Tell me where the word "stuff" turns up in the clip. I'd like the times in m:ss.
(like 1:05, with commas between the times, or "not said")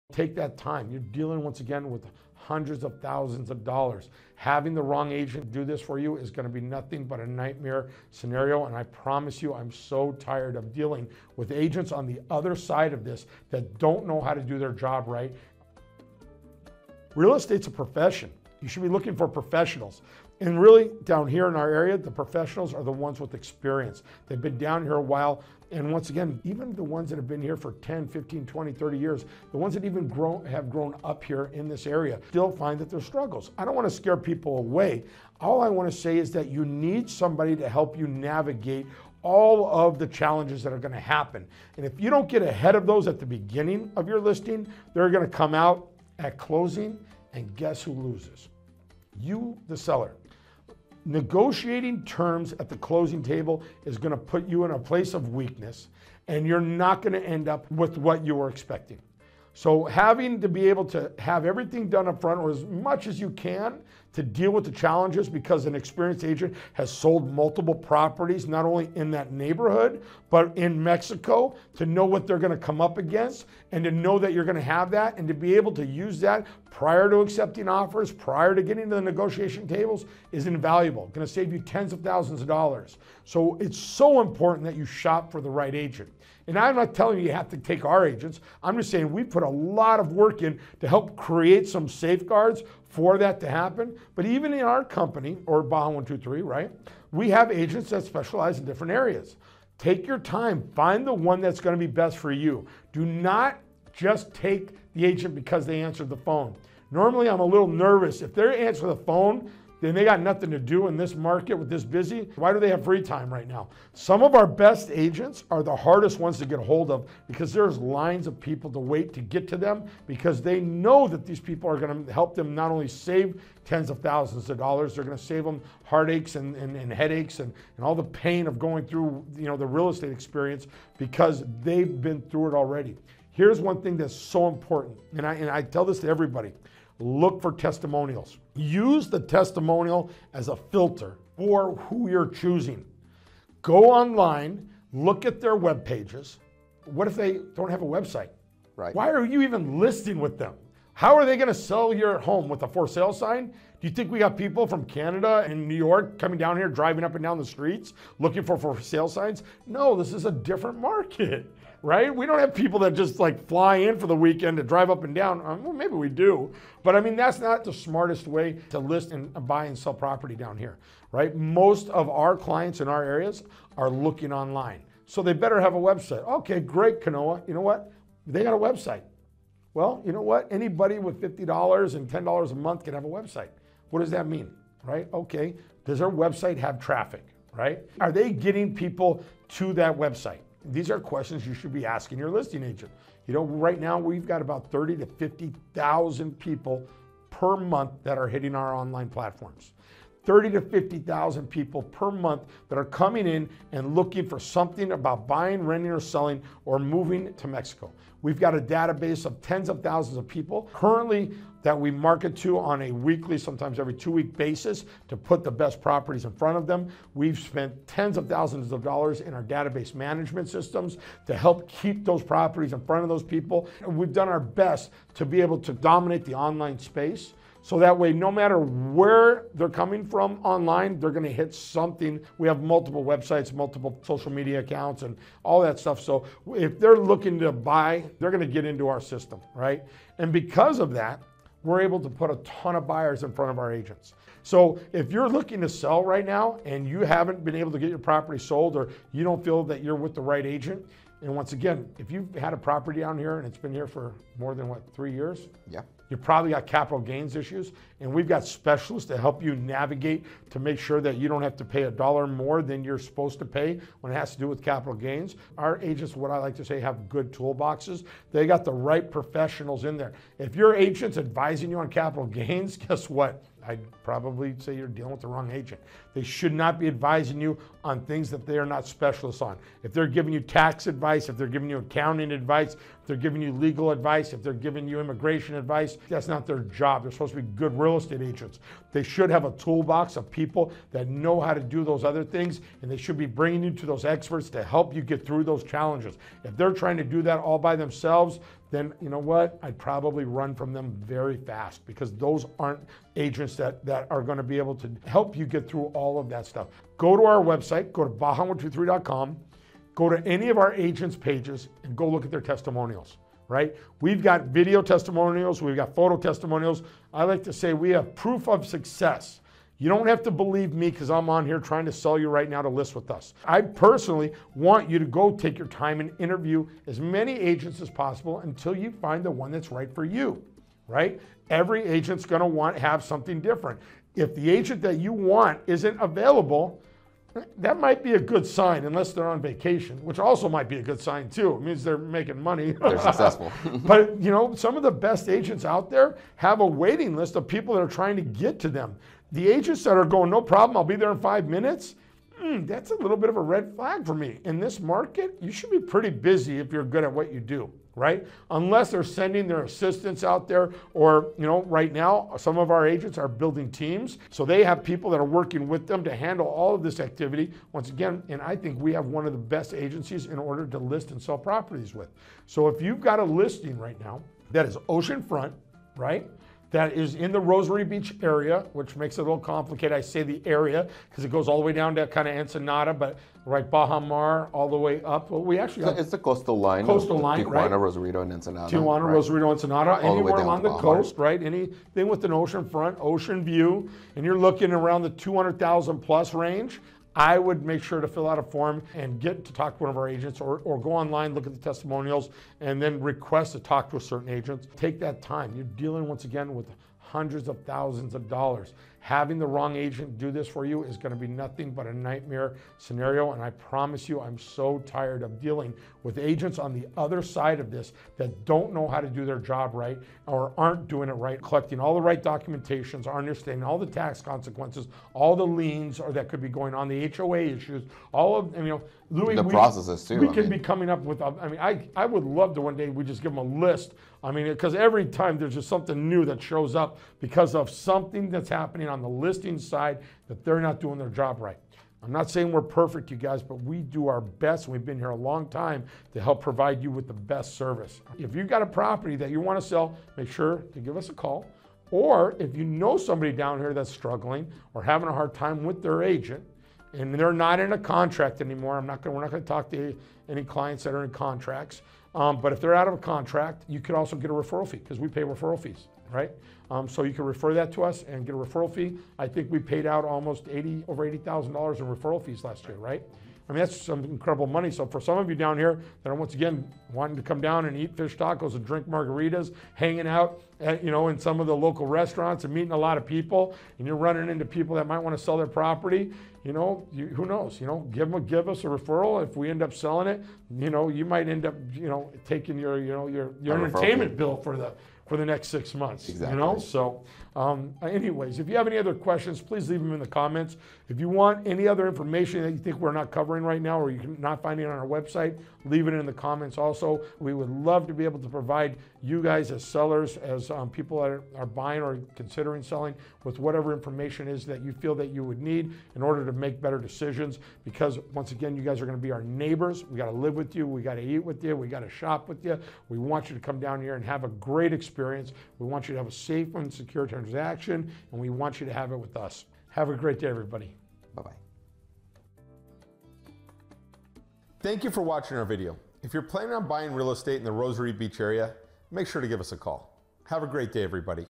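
3:55, 5:06.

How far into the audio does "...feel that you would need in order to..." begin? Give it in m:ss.
8:34.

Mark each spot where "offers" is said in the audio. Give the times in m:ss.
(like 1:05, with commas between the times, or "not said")
1:17.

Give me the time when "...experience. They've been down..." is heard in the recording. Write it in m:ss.
0:23.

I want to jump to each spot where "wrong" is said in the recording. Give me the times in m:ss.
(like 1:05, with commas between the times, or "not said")
0:04, 4:35, 6:49.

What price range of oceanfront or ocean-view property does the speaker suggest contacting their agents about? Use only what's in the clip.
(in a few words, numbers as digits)
$200,000 plus.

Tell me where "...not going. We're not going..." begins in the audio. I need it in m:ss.
7:38.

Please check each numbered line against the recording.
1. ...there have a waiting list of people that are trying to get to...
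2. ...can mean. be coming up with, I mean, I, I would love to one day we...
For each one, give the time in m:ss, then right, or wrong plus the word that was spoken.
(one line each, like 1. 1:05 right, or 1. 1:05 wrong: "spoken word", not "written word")
1. 5:45 right
2. 7:10 right.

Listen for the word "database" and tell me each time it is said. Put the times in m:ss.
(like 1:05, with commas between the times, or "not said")
3:28, 3:39.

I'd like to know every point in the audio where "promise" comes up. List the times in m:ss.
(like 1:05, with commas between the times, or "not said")
0:08, 6:53.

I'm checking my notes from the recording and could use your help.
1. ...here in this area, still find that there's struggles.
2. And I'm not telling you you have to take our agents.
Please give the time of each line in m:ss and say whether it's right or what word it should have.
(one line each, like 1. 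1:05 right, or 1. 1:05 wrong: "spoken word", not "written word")
1. 0:31 right
2. 1:26 right.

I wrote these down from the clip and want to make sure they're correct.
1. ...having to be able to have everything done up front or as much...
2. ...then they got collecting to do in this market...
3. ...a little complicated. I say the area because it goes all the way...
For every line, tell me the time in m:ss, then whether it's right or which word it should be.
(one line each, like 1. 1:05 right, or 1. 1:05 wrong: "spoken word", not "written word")
1. 0:59 right
2. 1:49 wrong: "nothing", not "collecting"
3. 6:19 right.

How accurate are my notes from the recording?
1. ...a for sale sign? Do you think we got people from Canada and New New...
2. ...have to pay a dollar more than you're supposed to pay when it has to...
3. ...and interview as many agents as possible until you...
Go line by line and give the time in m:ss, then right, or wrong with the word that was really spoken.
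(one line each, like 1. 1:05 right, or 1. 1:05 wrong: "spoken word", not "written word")
1. 2:32 wrong: "York", not "New"
2. 4:21 right
3. 5:25 right.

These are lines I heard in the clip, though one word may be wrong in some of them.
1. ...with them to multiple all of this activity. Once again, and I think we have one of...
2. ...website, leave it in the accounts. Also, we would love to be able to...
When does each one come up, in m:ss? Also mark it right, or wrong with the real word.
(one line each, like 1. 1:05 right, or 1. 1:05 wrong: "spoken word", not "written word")
1. 6:05 wrong: "handle", not "multiple"
2. 8:24 wrong: "comments", not "accounts".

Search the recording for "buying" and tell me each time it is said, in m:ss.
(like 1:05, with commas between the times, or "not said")
3:25, 8:31, 8:56.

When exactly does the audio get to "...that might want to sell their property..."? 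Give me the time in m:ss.
8:04.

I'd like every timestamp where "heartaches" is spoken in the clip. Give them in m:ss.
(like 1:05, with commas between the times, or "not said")
2:05.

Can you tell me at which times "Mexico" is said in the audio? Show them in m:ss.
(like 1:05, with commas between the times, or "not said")
1:10, 3:27.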